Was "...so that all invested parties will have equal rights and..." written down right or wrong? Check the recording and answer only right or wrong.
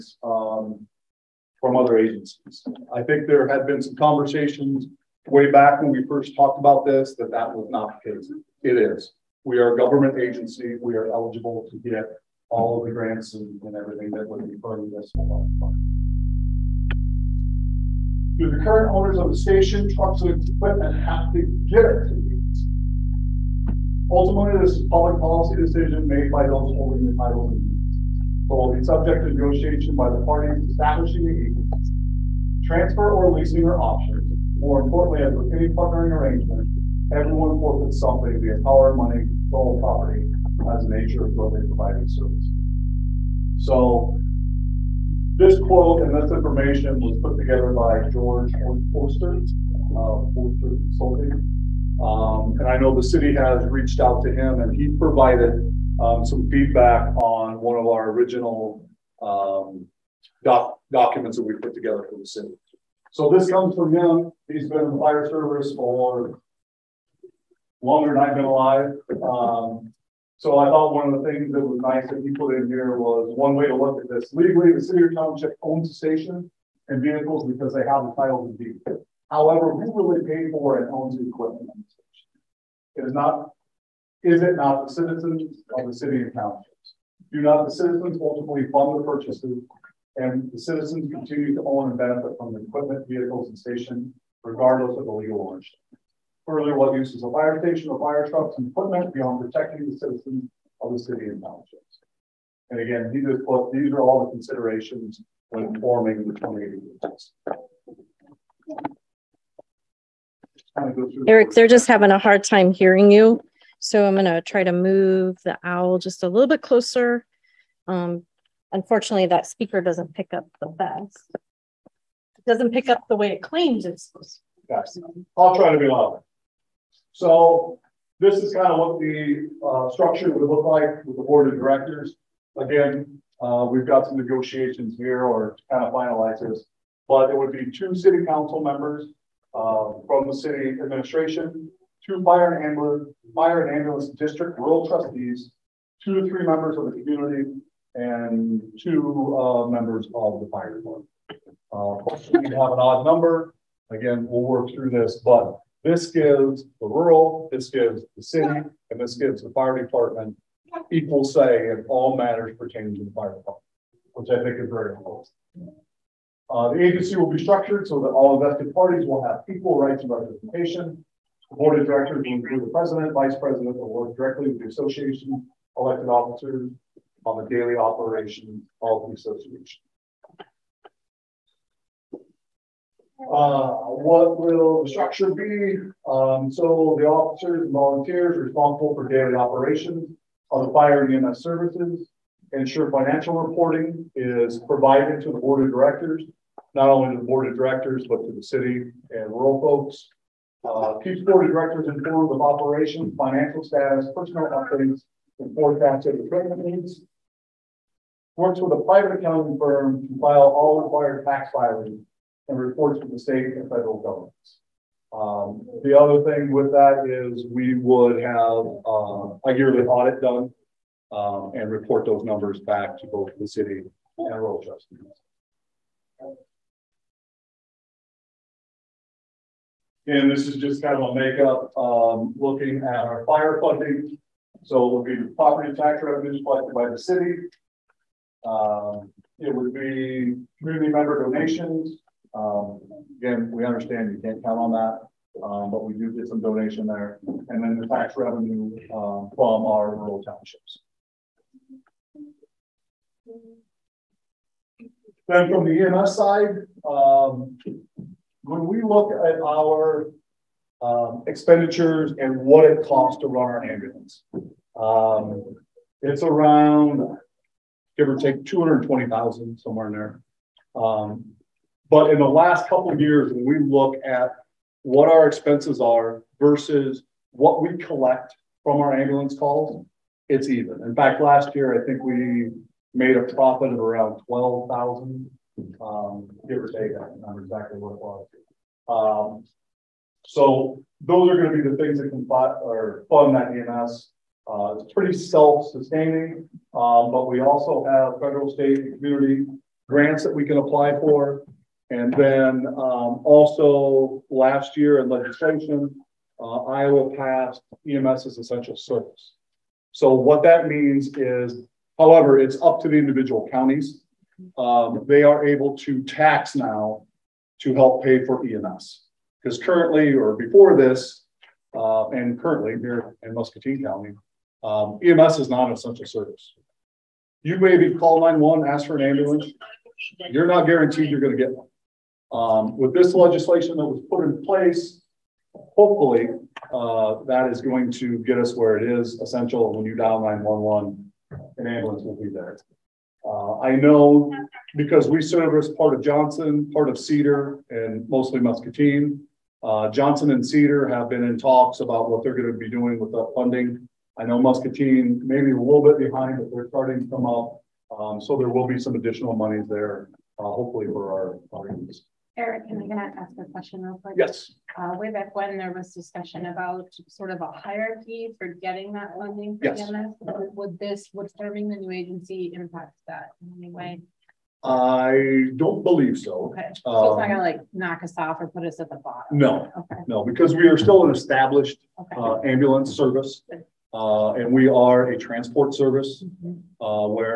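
right.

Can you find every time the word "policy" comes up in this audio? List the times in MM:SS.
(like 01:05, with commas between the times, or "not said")
00:25.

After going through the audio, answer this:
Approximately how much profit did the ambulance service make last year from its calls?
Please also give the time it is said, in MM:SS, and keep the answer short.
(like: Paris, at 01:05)
12,000, at 04:44.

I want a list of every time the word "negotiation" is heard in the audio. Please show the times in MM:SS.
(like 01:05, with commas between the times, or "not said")
00:29, 02:14.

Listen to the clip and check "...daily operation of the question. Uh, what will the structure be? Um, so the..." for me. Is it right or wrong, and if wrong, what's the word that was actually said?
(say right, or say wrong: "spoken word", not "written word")
wrong: "association", not "question".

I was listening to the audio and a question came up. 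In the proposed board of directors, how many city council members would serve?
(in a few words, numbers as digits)
2.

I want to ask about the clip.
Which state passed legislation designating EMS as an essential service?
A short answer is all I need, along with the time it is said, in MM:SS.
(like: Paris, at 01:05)
Iowa, at 05:06.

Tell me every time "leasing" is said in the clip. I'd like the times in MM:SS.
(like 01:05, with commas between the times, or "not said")
00:33.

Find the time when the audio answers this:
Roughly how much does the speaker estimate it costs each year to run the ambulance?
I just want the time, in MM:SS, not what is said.
04:28.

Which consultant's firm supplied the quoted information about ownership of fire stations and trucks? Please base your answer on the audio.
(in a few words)
Forster Consulting.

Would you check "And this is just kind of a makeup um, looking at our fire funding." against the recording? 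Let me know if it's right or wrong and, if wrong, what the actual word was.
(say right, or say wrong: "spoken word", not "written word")
right.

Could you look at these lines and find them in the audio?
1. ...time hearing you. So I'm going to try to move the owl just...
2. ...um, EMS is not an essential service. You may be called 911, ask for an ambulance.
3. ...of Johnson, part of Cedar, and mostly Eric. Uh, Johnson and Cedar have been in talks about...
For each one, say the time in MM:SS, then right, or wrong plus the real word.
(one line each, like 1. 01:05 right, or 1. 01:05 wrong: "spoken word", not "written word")
1. 01:52 right
2. 05:24 right
3. 05:45 wrong: "Muscatine", not "Eric".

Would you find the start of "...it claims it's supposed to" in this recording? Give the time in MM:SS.
02:03.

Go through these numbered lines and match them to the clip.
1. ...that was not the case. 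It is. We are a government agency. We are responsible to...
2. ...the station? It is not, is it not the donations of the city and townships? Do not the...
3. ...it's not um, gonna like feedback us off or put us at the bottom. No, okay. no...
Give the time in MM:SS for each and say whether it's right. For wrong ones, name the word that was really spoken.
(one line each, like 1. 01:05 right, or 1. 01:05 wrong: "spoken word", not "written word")
1. 00:07 wrong: "eligible", not "responsible"
2. 01:21 wrong: "citizens", not "donations"
3. 06:17 wrong: "knock", not "feedback".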